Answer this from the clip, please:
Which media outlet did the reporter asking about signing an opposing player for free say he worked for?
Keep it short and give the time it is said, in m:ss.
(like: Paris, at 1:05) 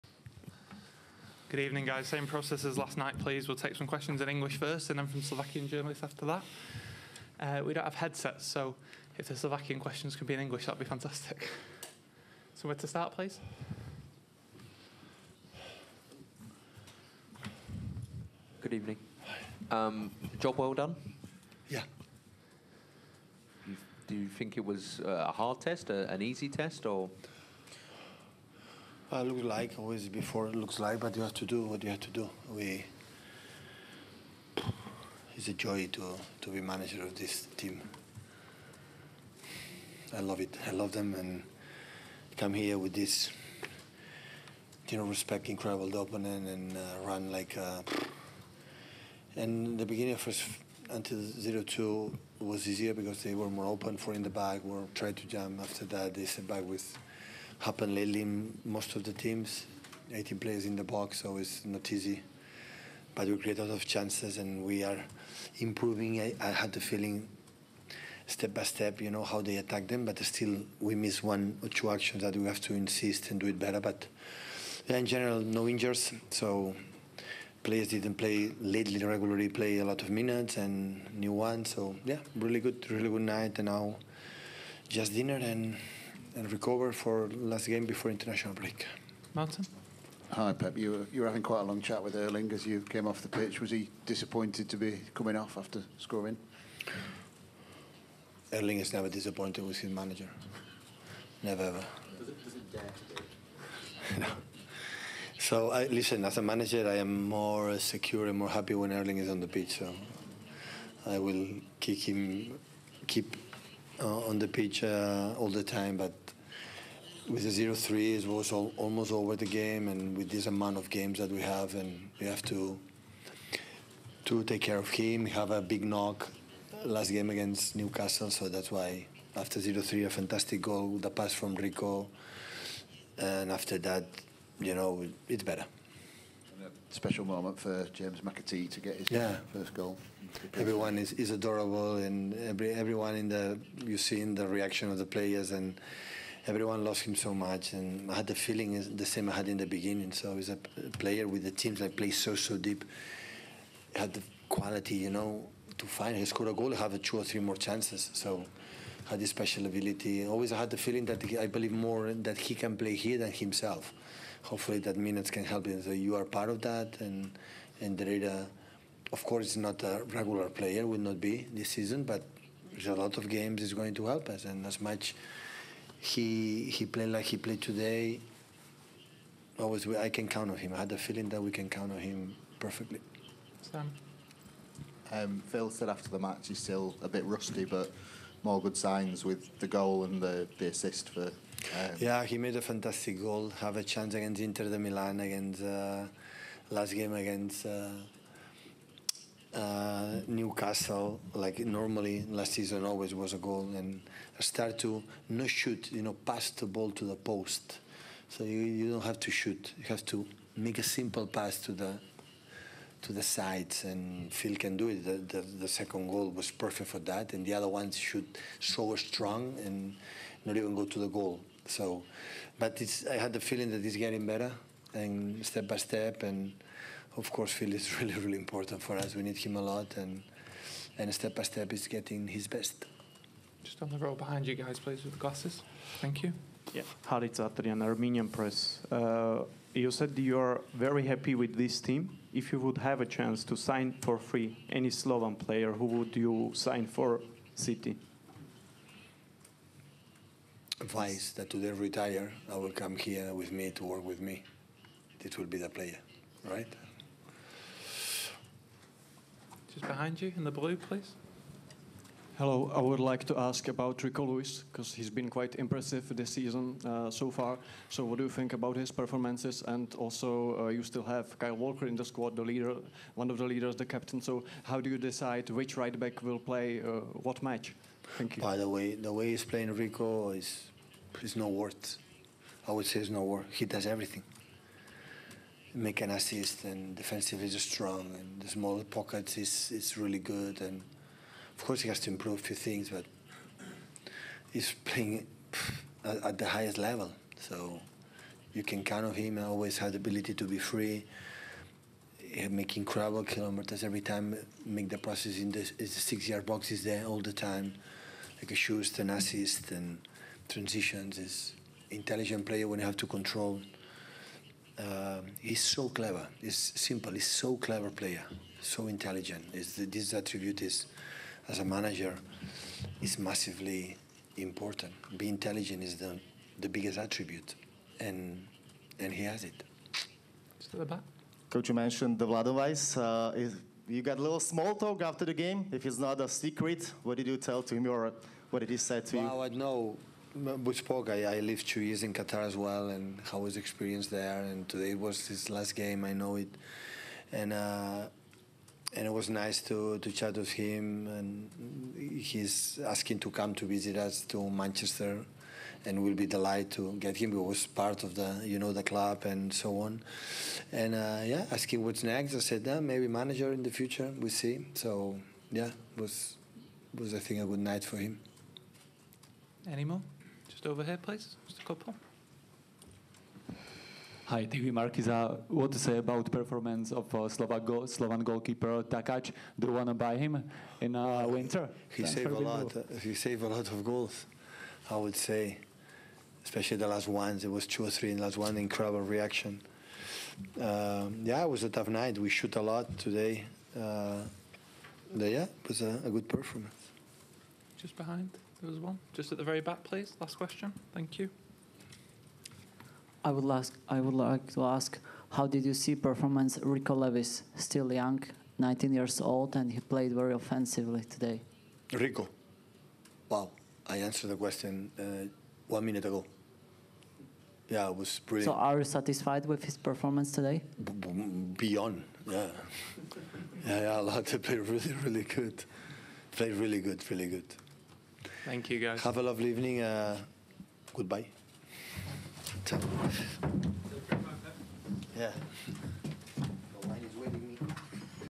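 Armenian Press, at 3:57.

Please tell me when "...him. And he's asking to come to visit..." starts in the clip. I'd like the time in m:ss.
5:50.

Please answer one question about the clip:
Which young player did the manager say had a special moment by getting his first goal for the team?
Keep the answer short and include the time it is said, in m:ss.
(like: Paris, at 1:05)
James McAtee, at 2:17.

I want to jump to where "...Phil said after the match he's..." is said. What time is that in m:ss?
3:05.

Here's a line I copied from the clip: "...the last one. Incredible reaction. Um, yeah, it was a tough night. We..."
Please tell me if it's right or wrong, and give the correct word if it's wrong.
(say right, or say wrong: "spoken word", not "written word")
right.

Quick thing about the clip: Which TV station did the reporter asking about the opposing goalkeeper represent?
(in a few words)
TV Markiza.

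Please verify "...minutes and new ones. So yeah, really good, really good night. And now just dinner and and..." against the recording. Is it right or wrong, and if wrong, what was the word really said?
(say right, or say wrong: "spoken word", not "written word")
right.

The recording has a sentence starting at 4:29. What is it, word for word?
And also, uh, you still have Kyle Walker in the squad, the leader, one of the leaders, the captain.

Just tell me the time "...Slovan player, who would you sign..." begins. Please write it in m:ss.
4:04.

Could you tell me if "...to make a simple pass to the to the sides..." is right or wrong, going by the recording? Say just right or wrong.
right.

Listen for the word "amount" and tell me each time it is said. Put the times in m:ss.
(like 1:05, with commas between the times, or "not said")
2:00.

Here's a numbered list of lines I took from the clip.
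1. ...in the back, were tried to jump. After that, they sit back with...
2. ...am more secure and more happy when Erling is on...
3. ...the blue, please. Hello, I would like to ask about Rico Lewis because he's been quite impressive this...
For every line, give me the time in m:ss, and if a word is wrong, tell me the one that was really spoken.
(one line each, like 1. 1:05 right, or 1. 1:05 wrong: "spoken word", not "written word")
1. 0:54 right
2. 1:46 right
3. 4:20 right.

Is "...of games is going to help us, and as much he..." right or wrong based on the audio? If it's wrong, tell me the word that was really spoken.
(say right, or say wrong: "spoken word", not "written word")
right.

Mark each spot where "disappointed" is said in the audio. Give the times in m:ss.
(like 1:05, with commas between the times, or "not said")
1:34, 1:39.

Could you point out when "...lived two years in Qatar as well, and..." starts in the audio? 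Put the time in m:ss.
5:41.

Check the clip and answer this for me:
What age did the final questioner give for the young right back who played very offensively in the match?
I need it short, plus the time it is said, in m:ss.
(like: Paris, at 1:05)
19, at 6:48.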